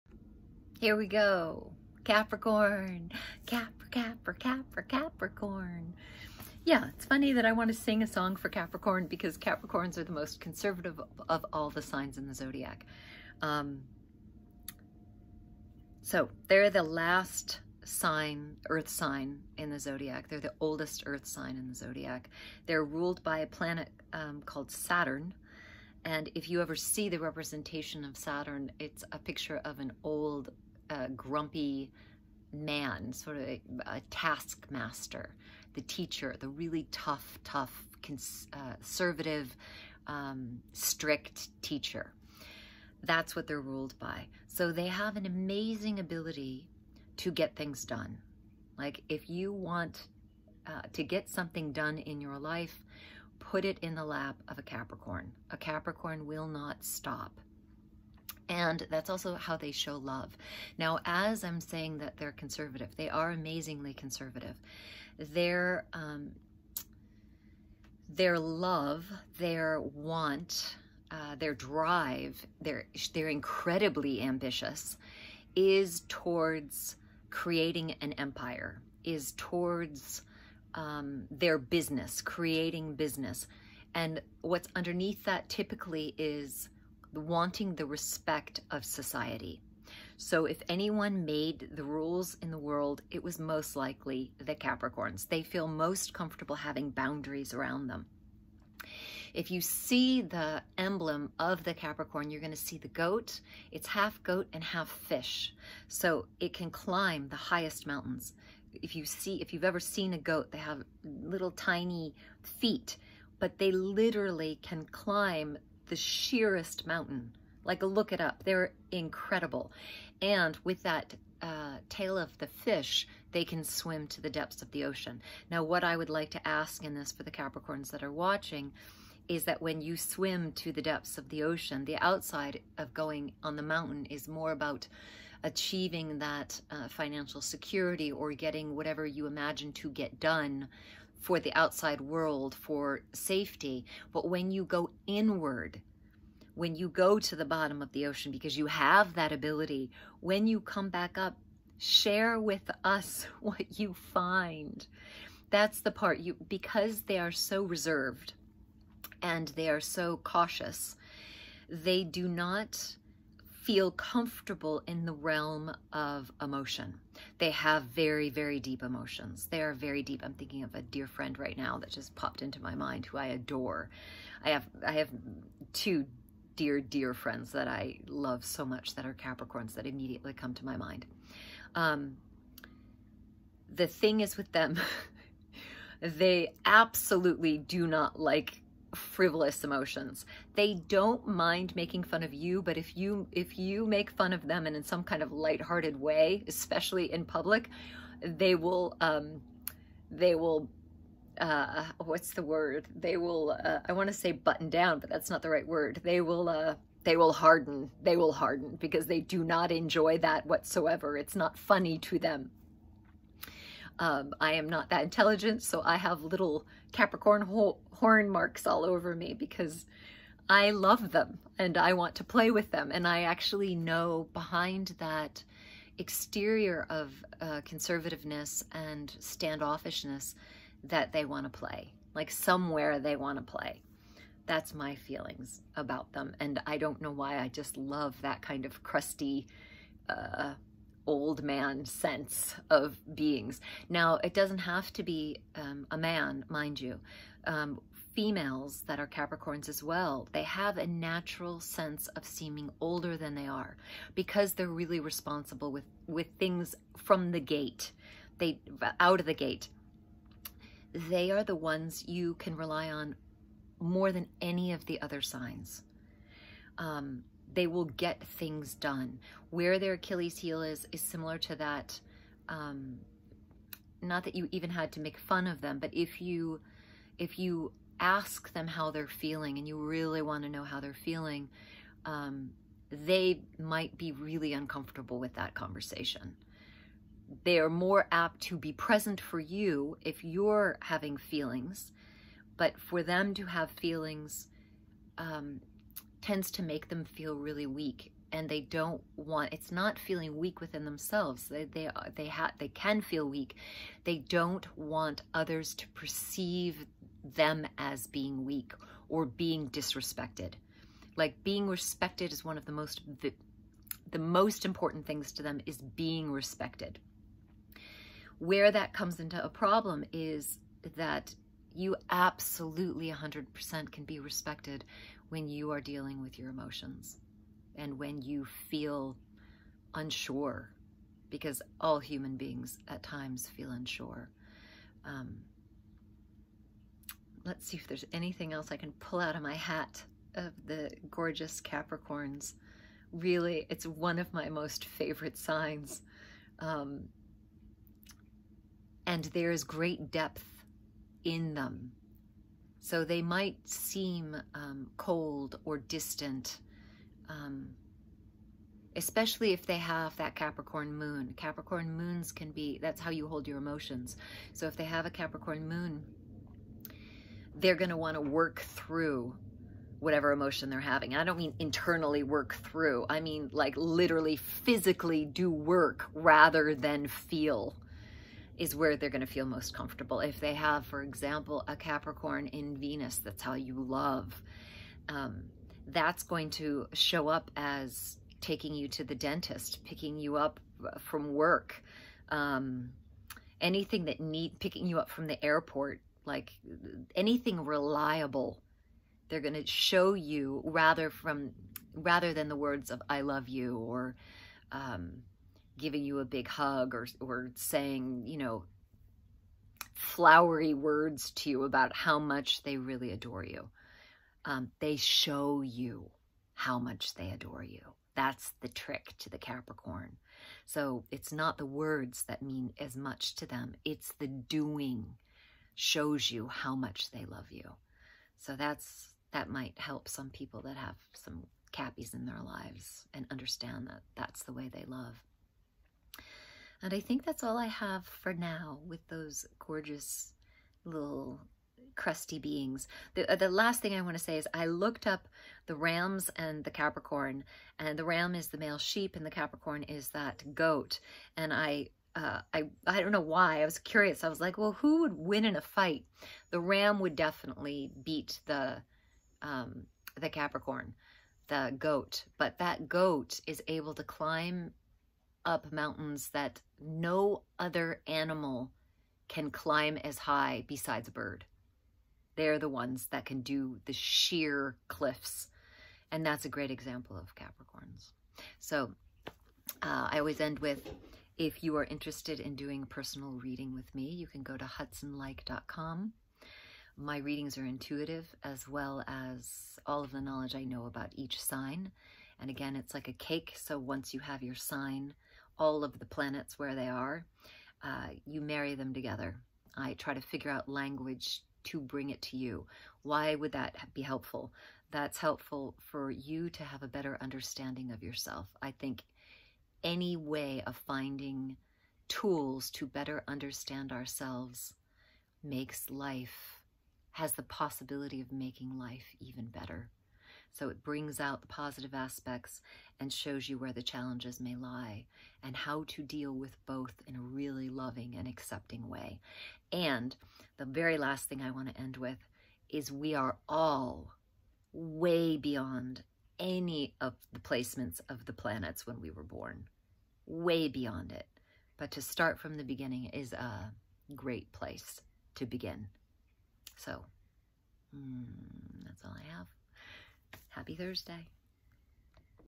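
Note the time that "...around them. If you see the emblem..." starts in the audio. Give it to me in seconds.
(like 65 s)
97 s.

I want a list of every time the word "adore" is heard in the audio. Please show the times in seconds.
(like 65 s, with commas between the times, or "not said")
173 s, 413 s, 417 s.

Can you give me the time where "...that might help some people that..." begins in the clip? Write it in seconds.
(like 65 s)
429 s.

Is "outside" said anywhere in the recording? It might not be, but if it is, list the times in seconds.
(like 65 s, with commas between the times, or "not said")
131 s, 141 s.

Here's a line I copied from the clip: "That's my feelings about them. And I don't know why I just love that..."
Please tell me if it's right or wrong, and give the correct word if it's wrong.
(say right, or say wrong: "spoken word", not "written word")
right.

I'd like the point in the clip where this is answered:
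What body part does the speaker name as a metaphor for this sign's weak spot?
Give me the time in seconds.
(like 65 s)
269 s.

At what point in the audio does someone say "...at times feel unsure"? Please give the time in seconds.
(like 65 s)
332 s.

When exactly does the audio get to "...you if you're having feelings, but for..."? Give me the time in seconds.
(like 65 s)
289 s.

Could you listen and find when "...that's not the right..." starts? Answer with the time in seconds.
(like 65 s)
205 s.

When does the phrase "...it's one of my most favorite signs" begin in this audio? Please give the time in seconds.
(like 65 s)
343 s.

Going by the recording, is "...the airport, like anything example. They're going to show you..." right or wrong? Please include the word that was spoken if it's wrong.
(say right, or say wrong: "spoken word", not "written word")
wrong: "reliable", not "example".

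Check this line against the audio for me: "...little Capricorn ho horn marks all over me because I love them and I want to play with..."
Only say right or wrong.
right.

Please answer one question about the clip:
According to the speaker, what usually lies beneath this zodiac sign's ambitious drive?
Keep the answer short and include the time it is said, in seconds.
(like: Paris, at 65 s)
The respect of society, at 87 s.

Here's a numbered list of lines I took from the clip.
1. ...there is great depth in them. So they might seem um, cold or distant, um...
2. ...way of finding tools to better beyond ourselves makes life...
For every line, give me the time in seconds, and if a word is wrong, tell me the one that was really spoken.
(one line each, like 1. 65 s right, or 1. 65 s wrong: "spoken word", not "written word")
1. 349 s right
2. 510 s wrong: "understand", not "beyond".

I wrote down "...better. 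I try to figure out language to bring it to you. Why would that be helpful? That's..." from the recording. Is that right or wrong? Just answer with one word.
wrong.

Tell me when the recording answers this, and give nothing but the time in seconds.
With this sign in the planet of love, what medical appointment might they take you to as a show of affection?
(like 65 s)
389 s.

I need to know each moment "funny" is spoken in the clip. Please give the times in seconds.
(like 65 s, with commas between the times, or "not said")
7 s, 211 s.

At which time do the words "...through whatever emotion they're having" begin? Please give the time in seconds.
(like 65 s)
368 s.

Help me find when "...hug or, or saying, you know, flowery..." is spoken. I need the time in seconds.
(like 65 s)
406 s.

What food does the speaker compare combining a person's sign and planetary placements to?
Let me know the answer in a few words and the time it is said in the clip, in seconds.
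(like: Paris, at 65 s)
A cake, at 493 s.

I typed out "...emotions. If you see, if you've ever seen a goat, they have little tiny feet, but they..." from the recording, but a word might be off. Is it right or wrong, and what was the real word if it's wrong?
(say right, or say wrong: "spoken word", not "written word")
wrong: "mountains", not "emotions".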